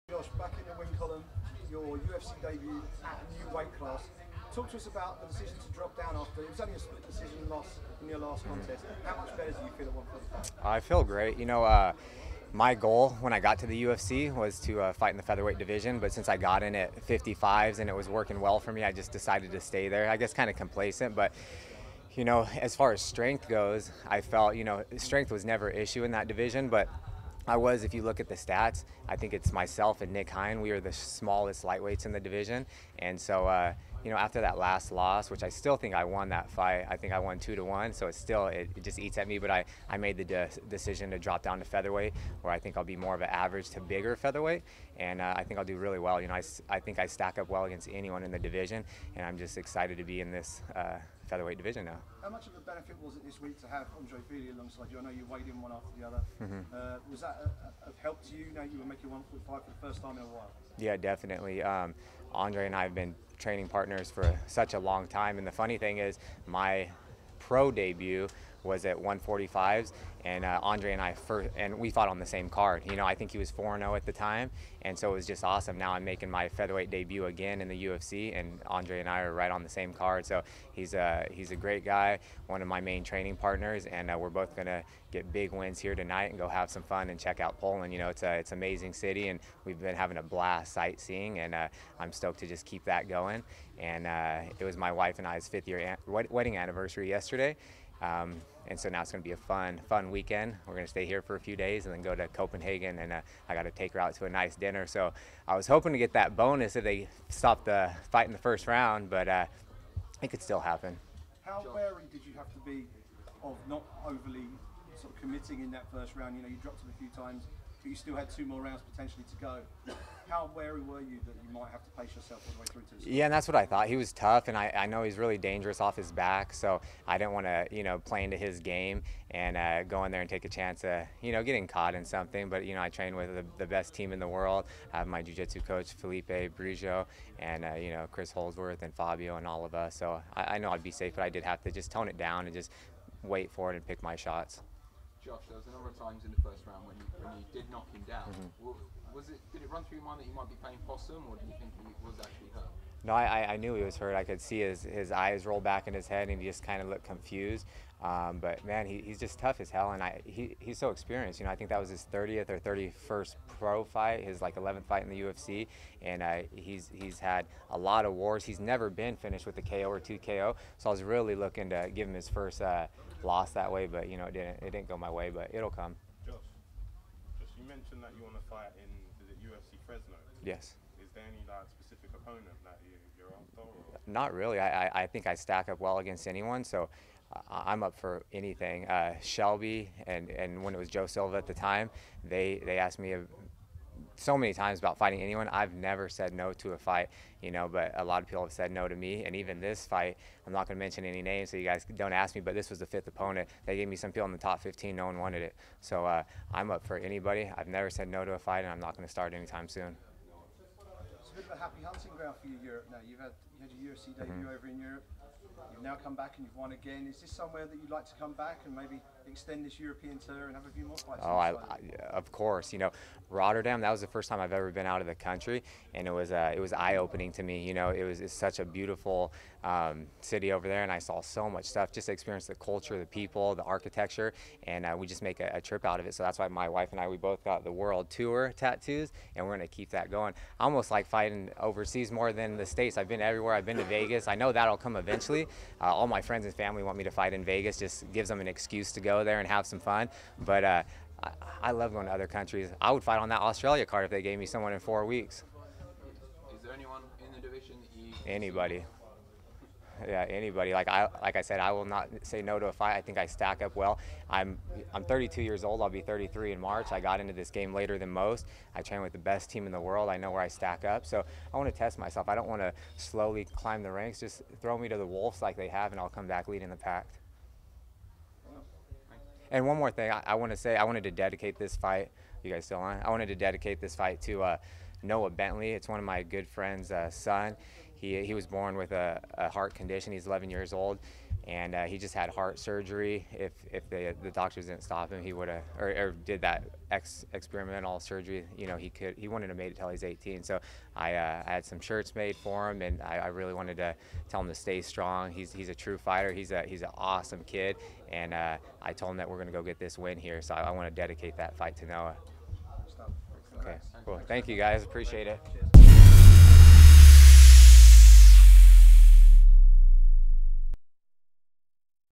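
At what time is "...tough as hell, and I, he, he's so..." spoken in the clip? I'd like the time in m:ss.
2:39.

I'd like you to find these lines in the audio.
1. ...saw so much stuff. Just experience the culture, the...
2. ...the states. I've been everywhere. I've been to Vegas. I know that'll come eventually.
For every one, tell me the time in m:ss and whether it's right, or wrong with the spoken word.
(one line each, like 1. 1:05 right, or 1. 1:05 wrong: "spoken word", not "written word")
1. 3:50 right
2. 4:02 right.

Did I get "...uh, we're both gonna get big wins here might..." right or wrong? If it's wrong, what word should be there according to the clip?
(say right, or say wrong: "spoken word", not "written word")
wrong: "tonight", not "might".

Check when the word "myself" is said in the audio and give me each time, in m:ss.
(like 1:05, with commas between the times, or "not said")
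0:29, 4:31.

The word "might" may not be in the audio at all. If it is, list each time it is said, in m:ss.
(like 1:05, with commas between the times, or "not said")
2:01, 2:30.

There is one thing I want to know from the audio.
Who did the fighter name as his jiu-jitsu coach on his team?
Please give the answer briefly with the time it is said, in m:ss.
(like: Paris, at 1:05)
Felipe Brugio, at 2:15.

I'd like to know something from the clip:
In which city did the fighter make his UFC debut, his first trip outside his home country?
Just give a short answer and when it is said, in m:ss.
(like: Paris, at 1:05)
Rotterdam, at 3:43.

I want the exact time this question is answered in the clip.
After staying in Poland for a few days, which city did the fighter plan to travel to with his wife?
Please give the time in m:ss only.
1:42.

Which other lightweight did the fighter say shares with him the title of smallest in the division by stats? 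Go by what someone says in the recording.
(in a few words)
Nick Hein.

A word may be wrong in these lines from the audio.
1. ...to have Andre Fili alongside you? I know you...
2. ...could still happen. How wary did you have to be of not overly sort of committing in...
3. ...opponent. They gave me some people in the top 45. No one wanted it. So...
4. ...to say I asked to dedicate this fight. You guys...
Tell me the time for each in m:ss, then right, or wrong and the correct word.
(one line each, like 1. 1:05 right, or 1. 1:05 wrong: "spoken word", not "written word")
1. 0:53 right
2. 1:50 right
3. 3:23 wrong: "15", not "45"
4. 4:40 wrong: "wanted", not "asked".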